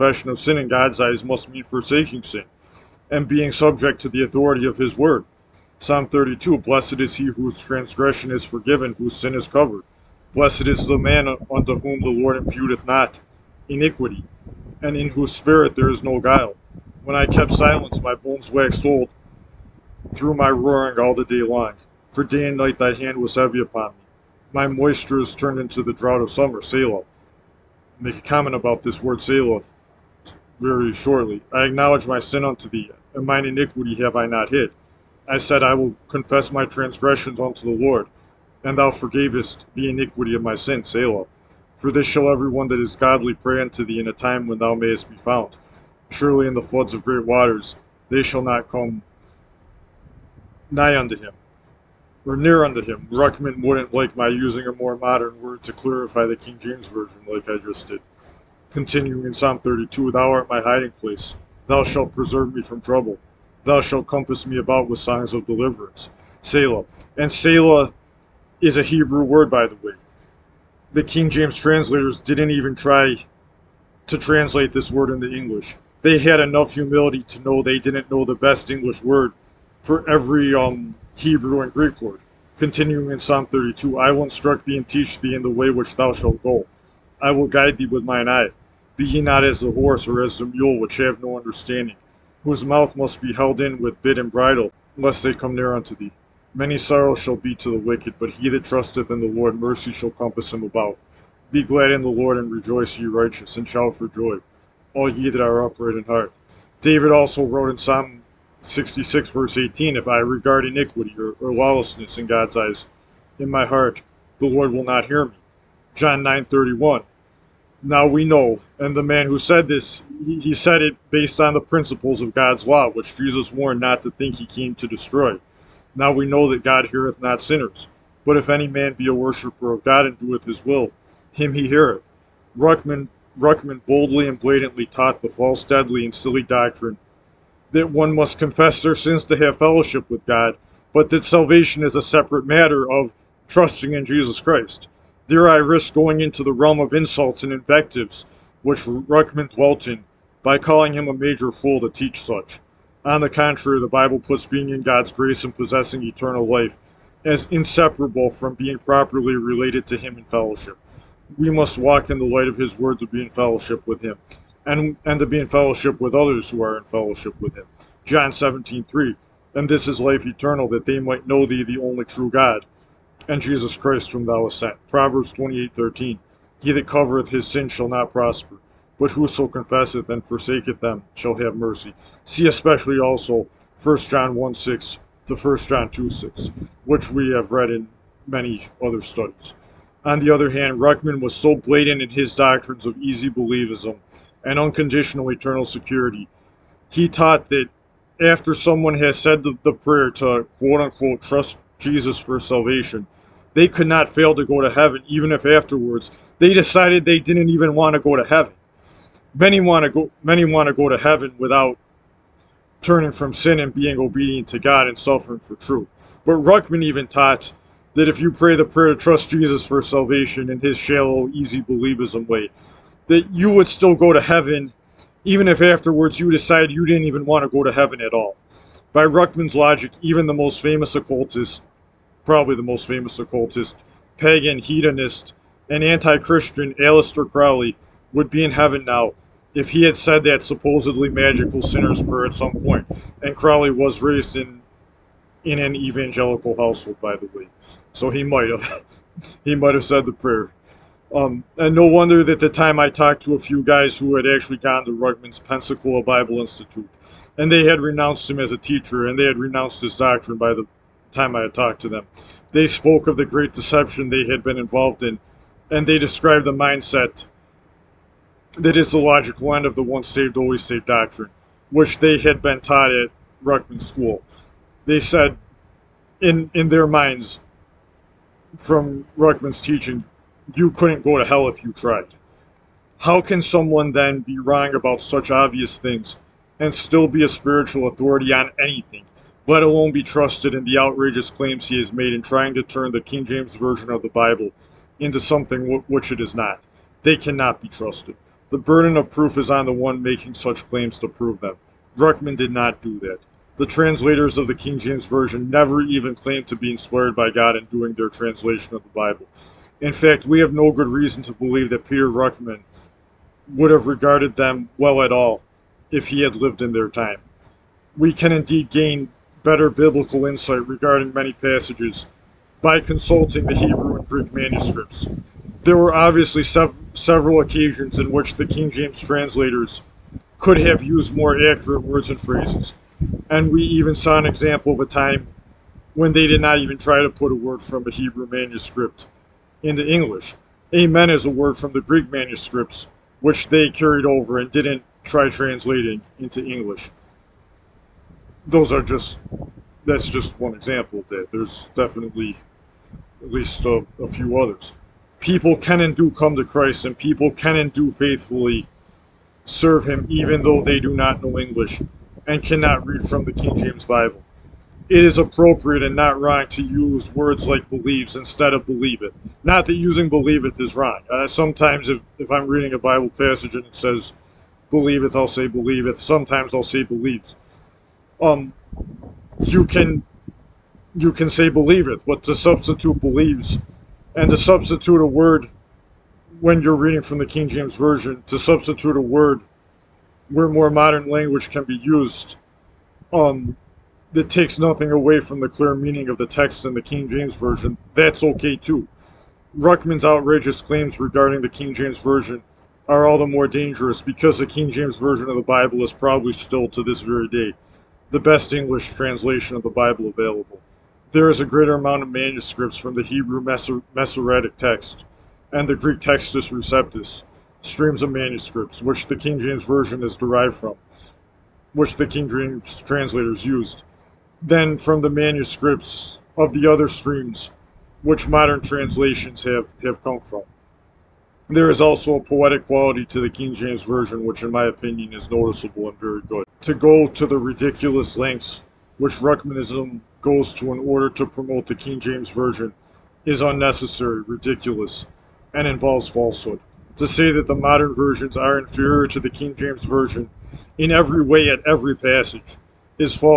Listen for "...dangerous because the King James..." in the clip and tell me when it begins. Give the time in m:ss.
6:43.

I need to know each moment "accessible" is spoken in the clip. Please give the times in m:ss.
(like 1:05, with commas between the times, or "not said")
not said.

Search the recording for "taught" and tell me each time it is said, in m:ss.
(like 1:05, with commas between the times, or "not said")
2:14, 3:17, 3:37, 4:32.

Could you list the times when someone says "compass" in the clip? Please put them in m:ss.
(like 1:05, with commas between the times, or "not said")
1:04, 1:40.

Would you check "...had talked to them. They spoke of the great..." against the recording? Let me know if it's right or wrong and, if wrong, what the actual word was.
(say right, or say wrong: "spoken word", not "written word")
right.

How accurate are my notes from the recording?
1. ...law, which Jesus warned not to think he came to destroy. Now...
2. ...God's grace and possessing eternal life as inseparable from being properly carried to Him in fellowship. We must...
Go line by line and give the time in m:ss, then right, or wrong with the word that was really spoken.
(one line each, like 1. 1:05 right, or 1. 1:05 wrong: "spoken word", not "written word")
1. 2:02 right
2. 2:34 wrong: "related", not "carried".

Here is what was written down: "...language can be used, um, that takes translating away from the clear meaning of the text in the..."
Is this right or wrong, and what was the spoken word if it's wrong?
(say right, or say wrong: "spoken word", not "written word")
wrong: "nothing", not "translating".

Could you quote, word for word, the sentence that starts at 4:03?
And Crowley was raised in in an evangelical household, by the way.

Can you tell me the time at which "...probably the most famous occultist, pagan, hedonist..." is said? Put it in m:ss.
3:52.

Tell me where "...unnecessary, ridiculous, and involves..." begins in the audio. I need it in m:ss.
7:23.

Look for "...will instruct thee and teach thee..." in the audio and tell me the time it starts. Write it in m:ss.
1:24.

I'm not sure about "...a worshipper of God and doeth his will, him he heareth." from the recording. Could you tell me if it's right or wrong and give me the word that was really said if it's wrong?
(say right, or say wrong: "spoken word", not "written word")
right.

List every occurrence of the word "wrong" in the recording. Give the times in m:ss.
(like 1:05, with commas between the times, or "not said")
4:44, 6:06, 6:10.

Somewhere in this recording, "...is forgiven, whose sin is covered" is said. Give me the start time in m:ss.
0:08.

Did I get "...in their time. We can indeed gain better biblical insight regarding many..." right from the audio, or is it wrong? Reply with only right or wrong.
right.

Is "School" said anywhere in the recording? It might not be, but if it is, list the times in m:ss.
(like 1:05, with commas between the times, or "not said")
4:33.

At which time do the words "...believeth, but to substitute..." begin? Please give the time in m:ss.
6:21.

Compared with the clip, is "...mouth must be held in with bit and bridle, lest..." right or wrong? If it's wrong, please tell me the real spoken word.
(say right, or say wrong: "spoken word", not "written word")
right.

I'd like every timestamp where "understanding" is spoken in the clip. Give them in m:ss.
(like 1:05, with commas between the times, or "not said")
1:31.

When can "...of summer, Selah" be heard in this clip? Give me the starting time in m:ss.
0:26.